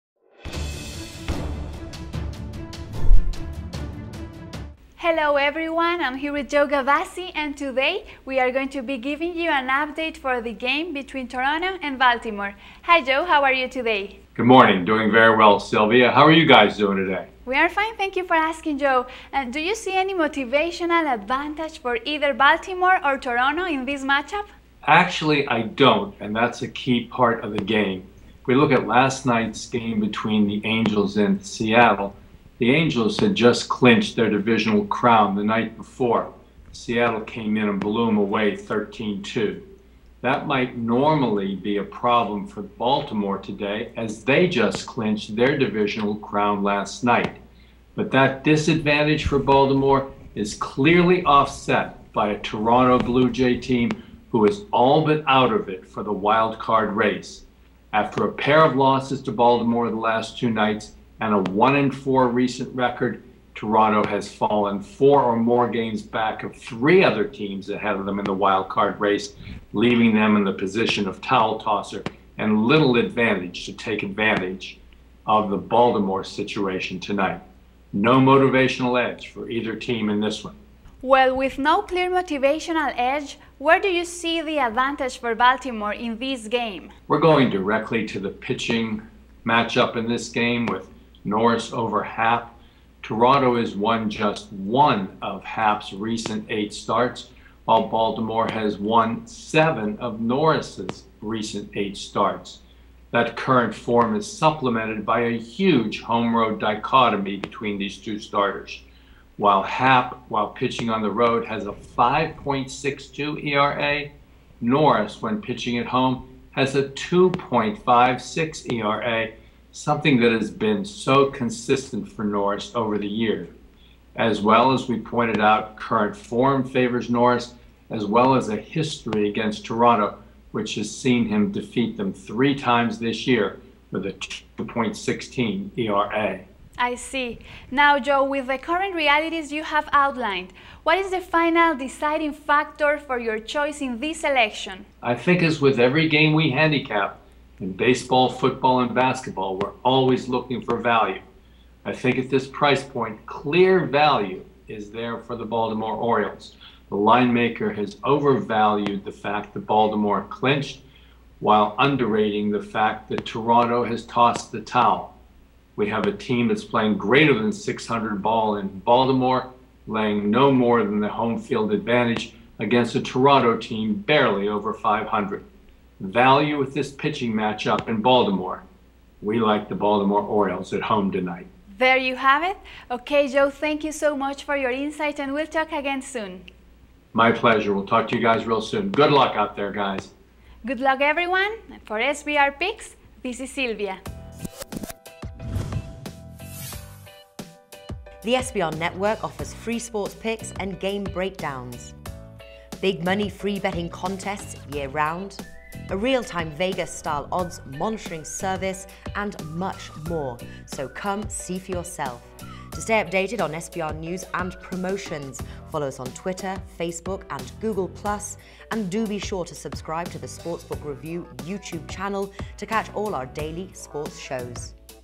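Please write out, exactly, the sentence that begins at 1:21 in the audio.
Well, with no clear motivational edge, where do you see the advantage for Baltimore in this game?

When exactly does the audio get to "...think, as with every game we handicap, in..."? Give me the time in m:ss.
2:25.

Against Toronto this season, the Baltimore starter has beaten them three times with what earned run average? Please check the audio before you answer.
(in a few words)
2.16.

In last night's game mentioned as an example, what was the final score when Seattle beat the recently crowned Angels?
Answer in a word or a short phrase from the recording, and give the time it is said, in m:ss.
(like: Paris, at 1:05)
13-2, at 0:38.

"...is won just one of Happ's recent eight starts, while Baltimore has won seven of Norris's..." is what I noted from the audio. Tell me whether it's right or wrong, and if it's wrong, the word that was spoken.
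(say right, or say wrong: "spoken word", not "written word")
right.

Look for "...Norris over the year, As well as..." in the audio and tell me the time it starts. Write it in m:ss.
2:02.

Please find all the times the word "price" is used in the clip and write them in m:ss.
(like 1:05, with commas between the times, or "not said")
2:32.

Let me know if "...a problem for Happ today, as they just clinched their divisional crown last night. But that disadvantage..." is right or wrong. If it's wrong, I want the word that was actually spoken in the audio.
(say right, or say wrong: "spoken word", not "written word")
wrong: "Baltimore", not "Happ".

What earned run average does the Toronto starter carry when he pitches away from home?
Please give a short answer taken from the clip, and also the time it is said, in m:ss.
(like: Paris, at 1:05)
5.62, at 1:51.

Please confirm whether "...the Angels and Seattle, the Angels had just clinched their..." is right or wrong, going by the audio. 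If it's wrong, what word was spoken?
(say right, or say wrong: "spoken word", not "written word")
right.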